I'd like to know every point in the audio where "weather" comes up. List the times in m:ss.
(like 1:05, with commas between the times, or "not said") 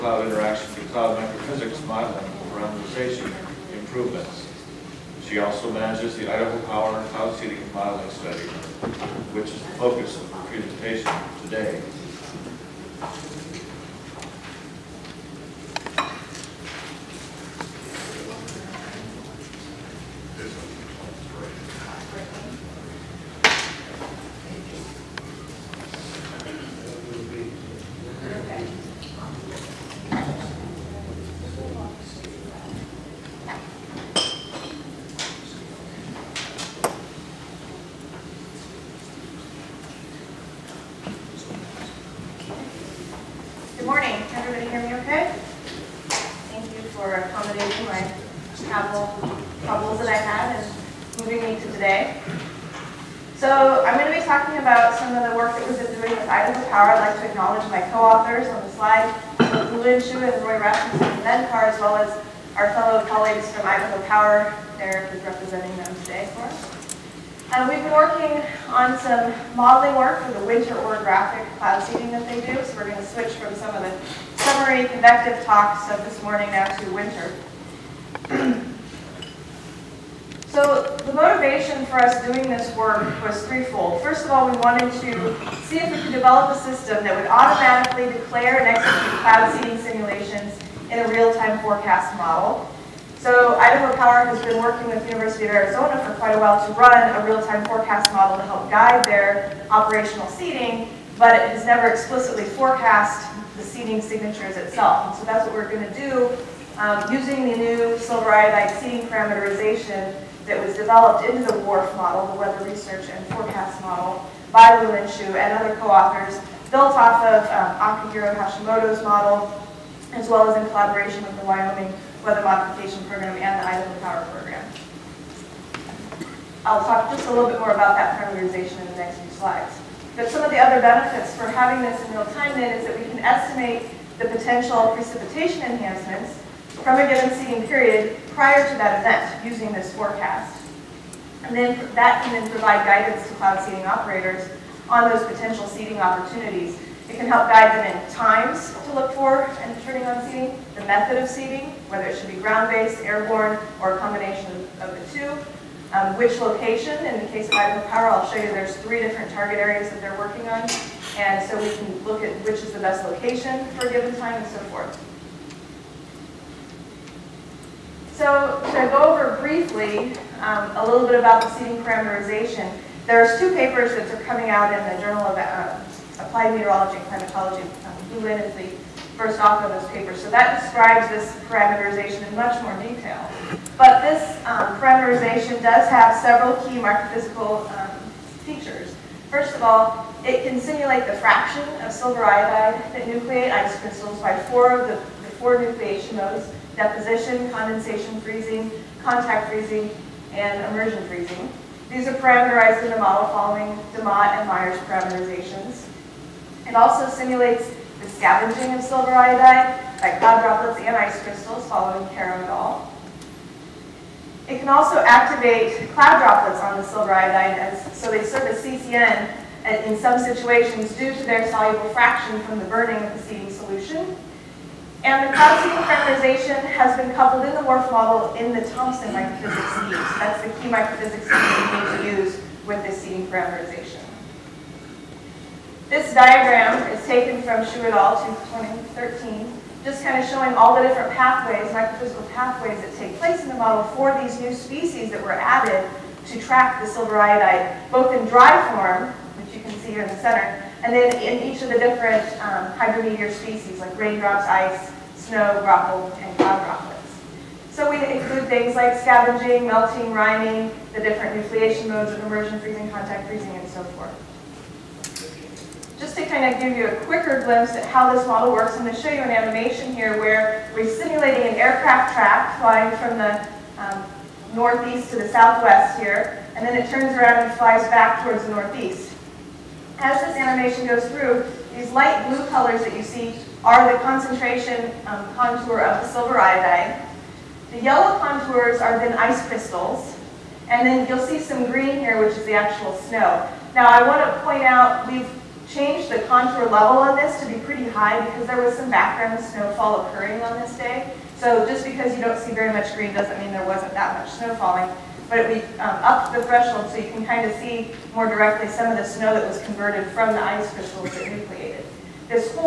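1:52, 2:02.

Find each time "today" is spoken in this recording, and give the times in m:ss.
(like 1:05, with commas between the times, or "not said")
0:11, 0:51, 1:06.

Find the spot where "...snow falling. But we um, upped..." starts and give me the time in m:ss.
5:04.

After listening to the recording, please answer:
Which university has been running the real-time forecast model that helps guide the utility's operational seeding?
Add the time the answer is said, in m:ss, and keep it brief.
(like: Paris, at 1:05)
University of Arizona, at 1:35.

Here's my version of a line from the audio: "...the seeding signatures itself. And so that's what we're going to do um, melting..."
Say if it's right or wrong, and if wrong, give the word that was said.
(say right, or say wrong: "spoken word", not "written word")
wrong: "using", not "melting".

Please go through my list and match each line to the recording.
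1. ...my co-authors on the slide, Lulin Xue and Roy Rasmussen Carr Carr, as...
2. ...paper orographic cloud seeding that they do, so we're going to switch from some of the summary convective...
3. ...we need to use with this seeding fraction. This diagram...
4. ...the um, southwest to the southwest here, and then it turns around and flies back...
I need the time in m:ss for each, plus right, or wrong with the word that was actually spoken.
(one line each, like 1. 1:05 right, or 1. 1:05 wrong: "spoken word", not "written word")
1. 0:57 wrong: "Ben", not "Carr"
2. 1:10 wrong: "winter", not "paper"
3. 3:52 wrong: "parameterization", not "fraction"
4. 4:33 wrong: "northeast", not "southwest".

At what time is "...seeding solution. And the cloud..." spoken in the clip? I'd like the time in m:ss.
3:43.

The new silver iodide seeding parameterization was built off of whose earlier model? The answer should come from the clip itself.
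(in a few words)
Akihiro Hashimoto.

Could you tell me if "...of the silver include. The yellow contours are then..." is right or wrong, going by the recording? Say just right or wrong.
wrong.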